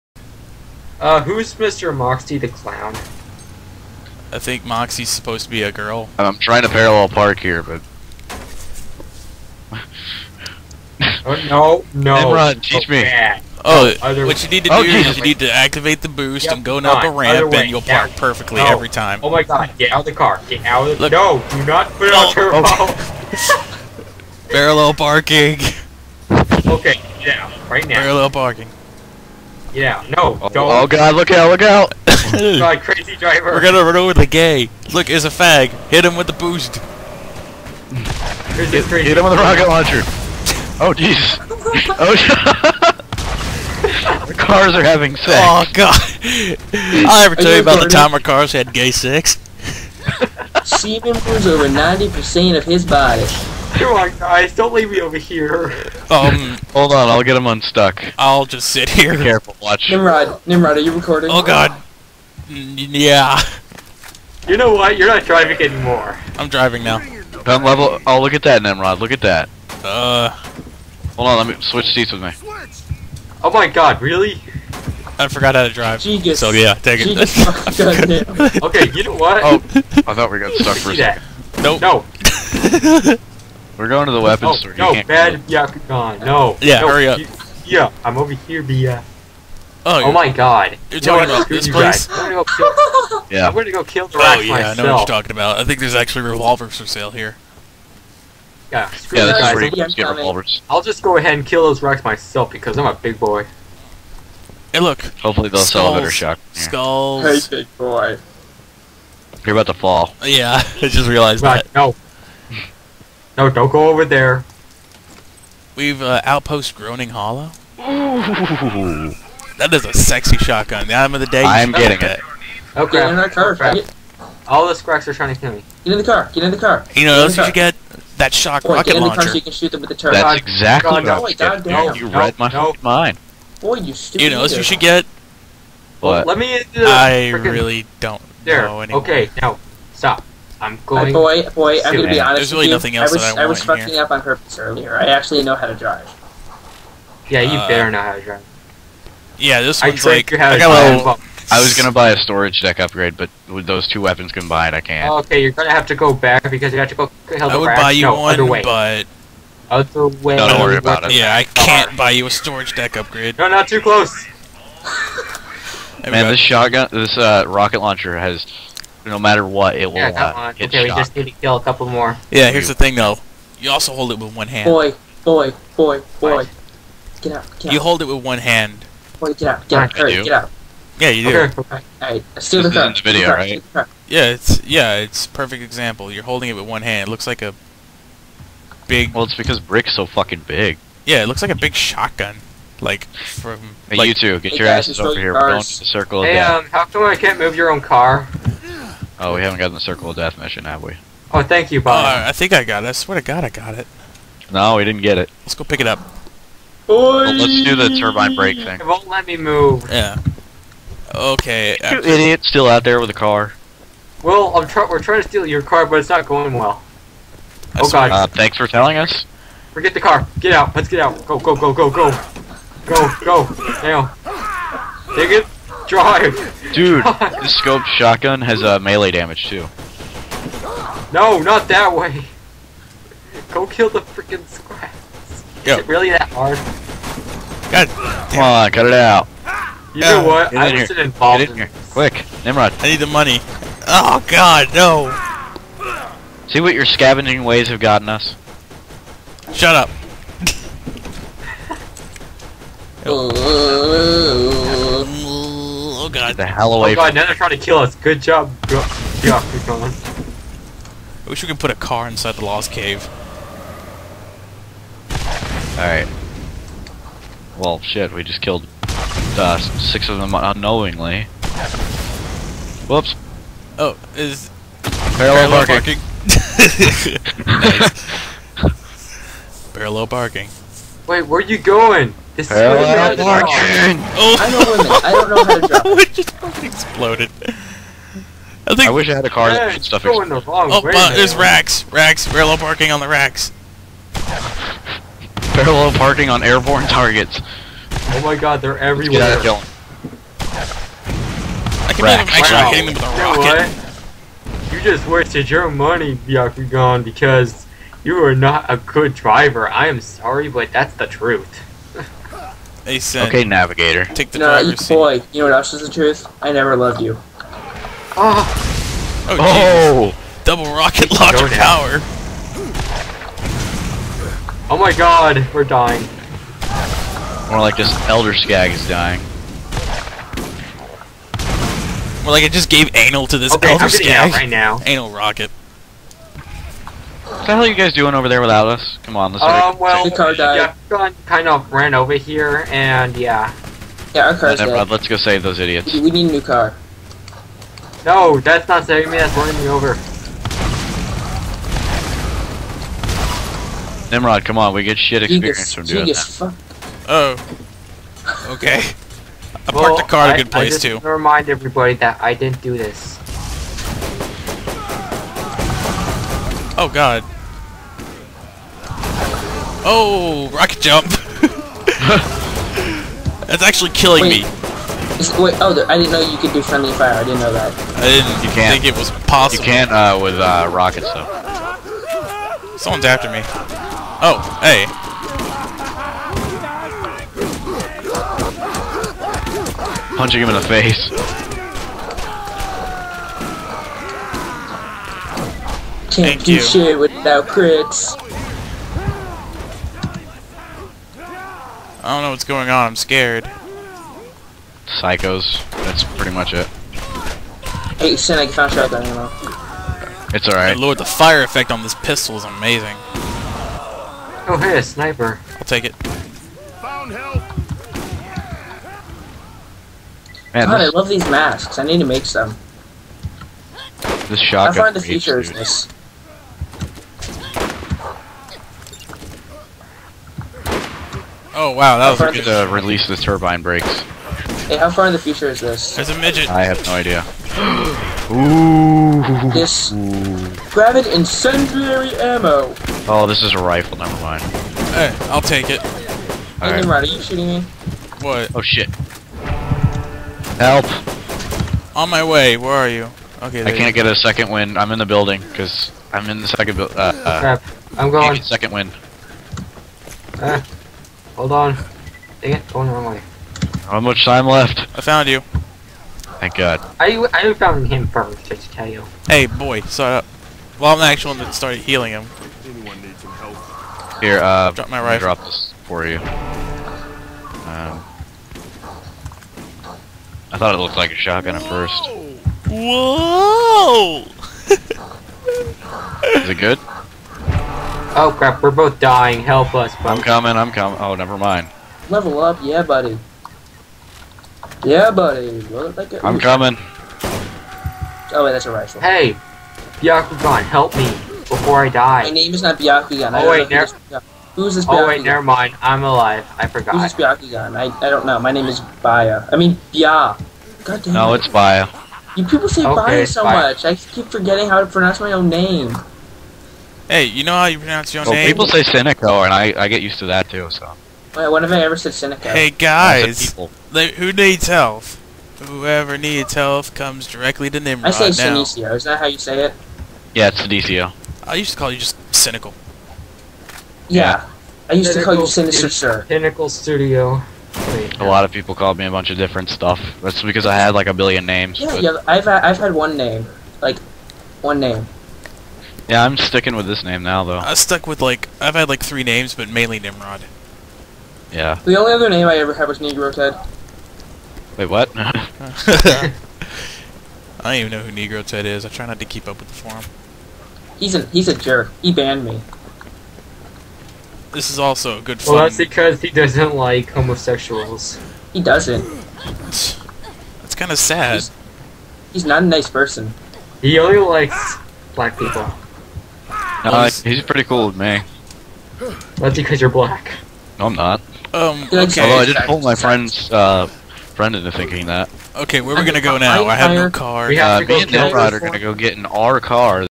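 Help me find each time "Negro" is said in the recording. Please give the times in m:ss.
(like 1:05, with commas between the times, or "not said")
9:12, 9:18.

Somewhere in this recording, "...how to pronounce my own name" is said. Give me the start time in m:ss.
8:34.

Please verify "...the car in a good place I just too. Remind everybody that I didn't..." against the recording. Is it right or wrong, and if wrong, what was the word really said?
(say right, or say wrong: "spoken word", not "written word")
right.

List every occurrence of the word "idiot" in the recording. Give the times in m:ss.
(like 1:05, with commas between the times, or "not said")
3:31, 5:45.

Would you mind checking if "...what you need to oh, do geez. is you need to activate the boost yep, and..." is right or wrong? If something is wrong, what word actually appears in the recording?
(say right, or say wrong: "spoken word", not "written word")
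right.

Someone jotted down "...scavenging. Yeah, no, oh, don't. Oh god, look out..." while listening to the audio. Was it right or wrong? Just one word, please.
wrong.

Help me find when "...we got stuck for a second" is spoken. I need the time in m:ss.
1:20.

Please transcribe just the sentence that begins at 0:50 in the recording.
Steven was over ninety percent of his body.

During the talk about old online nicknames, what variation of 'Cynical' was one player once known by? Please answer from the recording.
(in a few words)
Cynical Studio.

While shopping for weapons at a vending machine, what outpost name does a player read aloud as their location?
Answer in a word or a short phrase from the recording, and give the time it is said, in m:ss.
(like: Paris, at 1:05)
Groaning Hollow, at 1:56.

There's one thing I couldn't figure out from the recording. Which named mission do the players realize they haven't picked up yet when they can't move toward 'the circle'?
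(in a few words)
Circle of Death.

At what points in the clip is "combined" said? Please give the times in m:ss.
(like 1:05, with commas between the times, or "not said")
2:34.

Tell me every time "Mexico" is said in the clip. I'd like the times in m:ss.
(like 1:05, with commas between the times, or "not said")
not said.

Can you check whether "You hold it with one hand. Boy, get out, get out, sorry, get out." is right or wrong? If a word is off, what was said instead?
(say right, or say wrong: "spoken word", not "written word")
wrong: "hurry", not "sorry".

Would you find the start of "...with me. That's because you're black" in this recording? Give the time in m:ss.
9:37.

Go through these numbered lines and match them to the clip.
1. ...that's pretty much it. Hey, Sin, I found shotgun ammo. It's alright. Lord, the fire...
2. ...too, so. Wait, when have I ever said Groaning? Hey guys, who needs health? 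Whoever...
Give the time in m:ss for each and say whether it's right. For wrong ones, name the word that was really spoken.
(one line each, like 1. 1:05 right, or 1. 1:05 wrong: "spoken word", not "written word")
1. 6:45 right
2. 8:40 wrong: "Seneca", not "Groaning".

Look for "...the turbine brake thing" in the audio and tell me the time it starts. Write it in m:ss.
3:27.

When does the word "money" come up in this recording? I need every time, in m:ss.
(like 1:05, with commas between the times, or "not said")
4:03, 5:05.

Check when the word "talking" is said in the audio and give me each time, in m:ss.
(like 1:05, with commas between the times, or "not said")
1:30, 1:35.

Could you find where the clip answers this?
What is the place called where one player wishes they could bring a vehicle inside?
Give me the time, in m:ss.
4:22.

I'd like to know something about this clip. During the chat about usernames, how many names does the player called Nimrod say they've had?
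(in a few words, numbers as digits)
3.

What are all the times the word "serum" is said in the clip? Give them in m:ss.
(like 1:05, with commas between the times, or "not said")
not said.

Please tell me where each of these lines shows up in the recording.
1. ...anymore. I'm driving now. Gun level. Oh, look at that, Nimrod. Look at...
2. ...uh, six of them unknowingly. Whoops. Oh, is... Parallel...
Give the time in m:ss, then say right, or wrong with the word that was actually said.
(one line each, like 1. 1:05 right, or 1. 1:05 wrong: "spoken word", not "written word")
1. 1:05 right
2. 4:28 right.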